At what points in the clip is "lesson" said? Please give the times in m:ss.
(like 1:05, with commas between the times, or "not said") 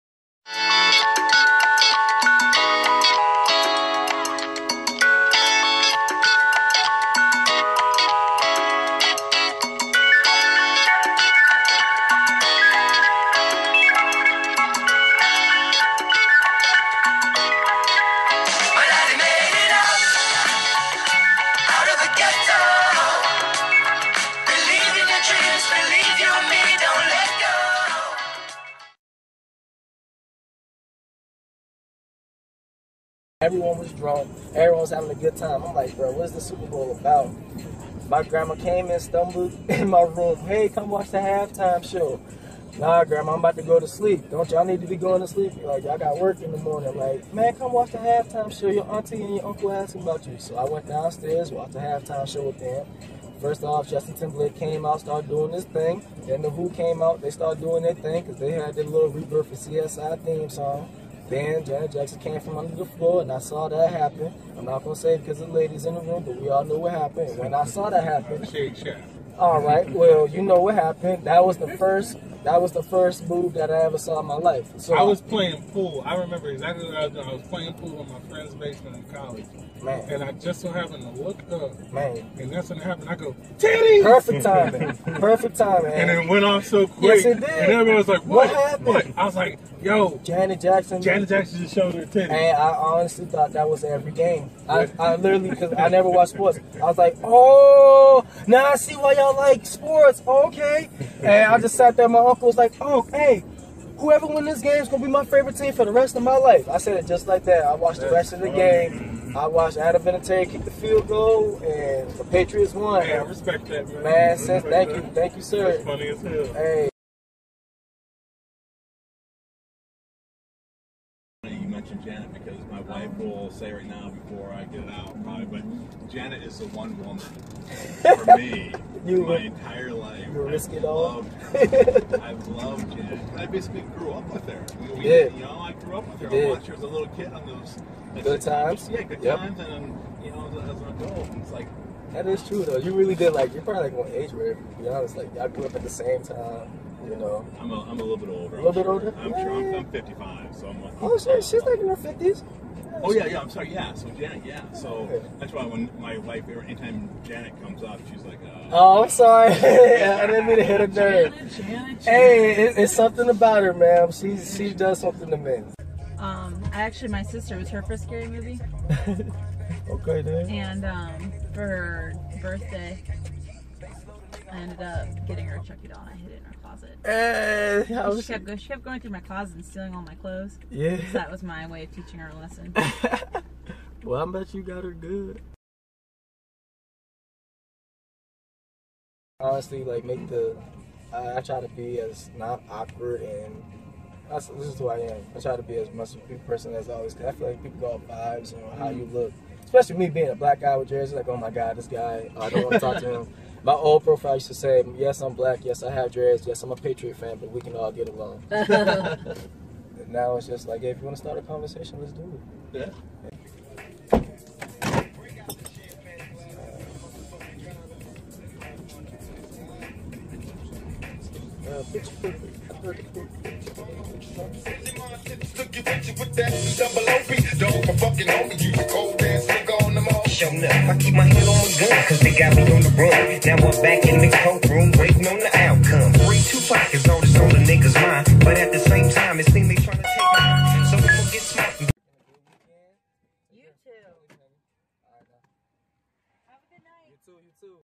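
3:02.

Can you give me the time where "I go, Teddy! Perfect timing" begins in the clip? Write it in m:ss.
1:23.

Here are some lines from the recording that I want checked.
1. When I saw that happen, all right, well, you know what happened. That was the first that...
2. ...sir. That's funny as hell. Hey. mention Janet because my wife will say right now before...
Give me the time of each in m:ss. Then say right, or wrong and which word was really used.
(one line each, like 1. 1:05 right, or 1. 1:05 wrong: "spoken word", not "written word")
1. 1:07 right
2. 1:55 right.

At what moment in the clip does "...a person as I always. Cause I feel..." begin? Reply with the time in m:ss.
3:16.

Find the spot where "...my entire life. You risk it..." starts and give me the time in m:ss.
2:09.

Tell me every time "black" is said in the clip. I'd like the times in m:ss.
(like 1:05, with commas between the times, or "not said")
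3:20, 3:25.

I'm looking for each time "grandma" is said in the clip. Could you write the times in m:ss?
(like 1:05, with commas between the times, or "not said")
0:38, 0:43.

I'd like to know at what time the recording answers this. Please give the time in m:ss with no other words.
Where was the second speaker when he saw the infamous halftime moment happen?
1:18.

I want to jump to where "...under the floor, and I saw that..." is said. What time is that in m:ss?
1:02.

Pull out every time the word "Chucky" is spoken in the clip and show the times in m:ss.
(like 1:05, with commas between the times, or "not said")
2:55.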